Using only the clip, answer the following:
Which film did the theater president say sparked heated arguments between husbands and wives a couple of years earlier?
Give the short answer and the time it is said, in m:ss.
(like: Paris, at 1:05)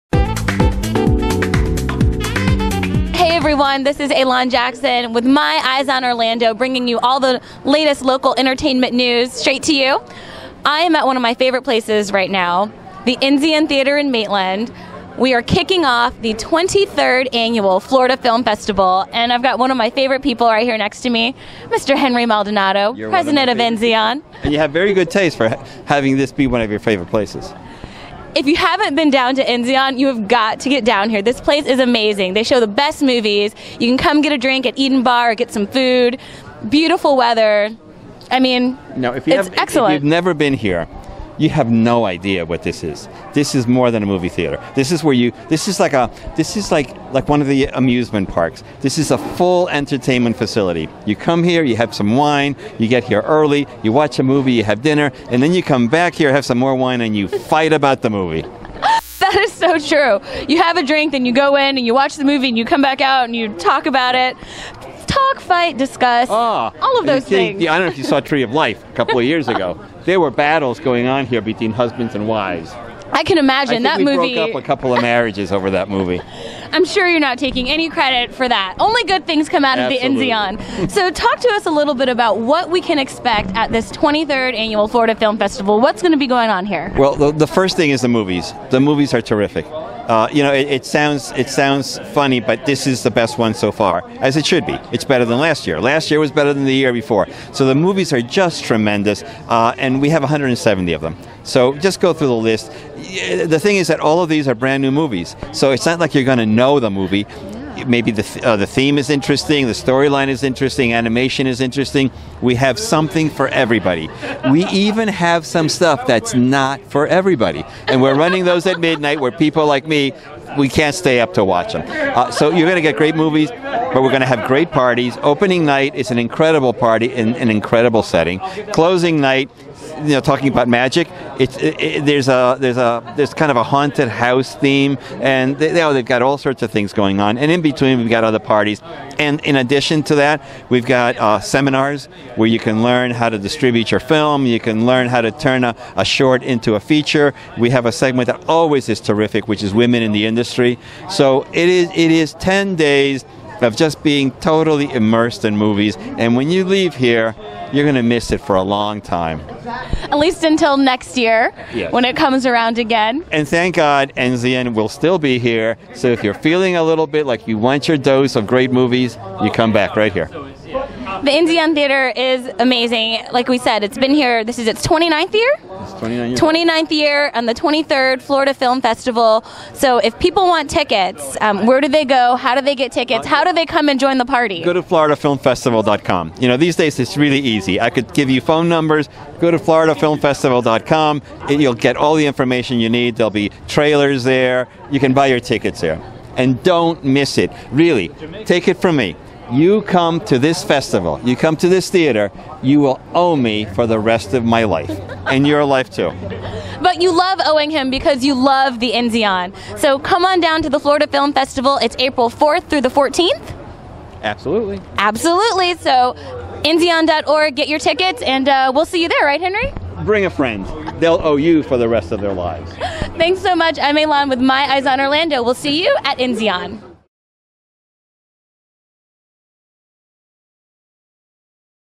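Tree of Life, at 1:08.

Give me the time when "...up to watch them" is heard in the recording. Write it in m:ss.
2:01.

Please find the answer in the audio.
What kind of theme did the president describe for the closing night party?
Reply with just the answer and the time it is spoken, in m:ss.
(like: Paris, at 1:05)
haunted house, at 2:13.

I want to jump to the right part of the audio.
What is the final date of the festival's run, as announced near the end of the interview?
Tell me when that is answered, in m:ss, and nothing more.
3:32.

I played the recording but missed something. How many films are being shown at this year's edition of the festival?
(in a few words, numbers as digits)
170.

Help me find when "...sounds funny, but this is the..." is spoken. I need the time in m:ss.
1:31.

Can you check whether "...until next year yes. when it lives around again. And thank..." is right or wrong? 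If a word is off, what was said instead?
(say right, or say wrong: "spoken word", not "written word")
wrong: "comes", not "lives".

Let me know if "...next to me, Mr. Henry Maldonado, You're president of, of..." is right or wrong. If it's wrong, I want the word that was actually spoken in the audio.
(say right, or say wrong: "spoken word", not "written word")
right.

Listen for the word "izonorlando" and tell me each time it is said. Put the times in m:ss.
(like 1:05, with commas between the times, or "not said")
0:05, 3:44.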